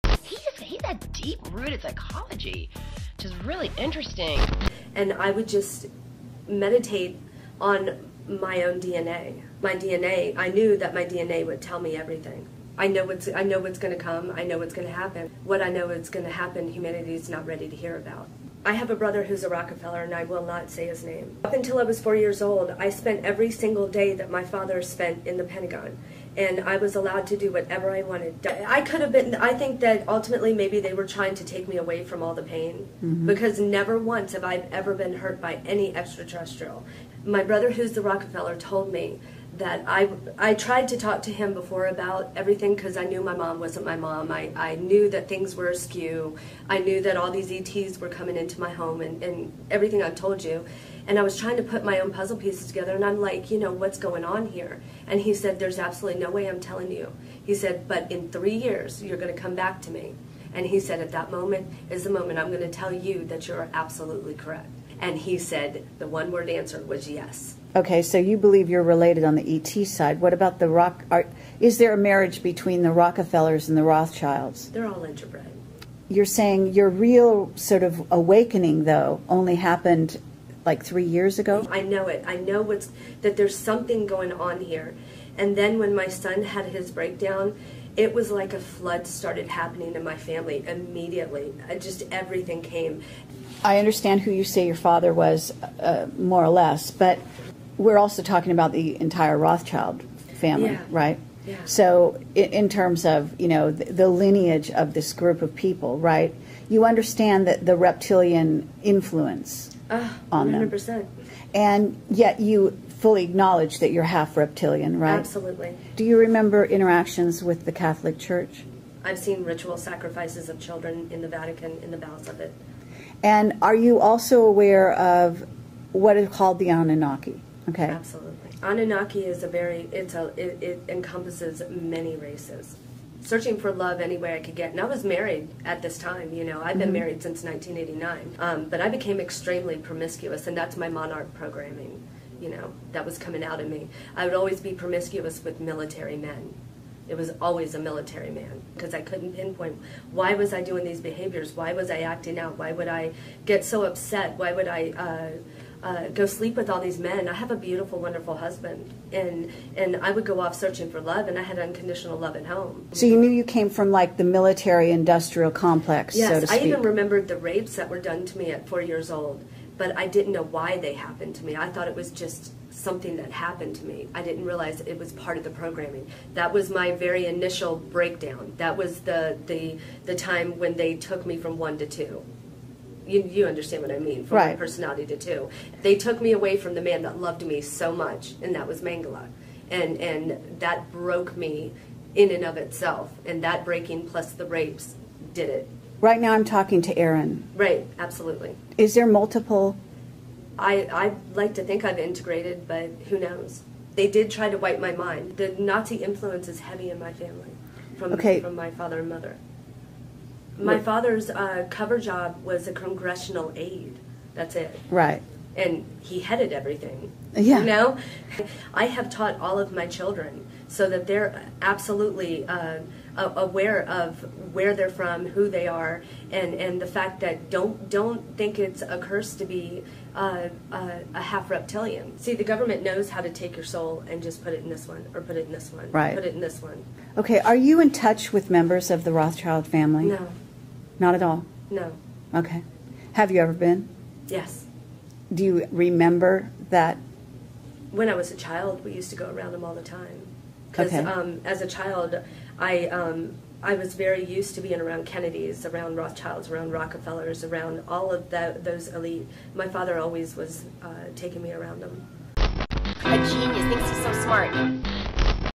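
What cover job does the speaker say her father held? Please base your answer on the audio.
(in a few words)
Congressional aide.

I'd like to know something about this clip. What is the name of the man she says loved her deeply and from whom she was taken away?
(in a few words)
Mangala.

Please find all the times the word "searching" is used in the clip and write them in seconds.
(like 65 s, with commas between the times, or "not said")
133 s, 160 s.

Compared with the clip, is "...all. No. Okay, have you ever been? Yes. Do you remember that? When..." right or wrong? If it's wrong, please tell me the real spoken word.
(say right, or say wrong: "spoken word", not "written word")
right.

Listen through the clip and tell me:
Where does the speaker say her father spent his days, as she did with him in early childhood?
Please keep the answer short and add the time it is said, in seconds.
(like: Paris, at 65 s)
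Pentagon, at 25 s.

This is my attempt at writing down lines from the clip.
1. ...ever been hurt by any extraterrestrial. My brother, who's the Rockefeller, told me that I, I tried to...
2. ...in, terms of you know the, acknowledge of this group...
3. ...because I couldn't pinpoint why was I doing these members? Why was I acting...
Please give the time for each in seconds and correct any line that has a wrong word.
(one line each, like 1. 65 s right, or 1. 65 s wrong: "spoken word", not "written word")
1. 34 s right
2. 102 s wrong: "lineage", not "acknowledge"
3. 148 s wrong: "behaviors", not "members".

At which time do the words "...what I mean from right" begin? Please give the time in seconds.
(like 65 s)
183 s.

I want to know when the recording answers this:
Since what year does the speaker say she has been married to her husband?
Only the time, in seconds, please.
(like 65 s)
137 s.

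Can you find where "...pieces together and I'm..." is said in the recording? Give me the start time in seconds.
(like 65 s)
52 s.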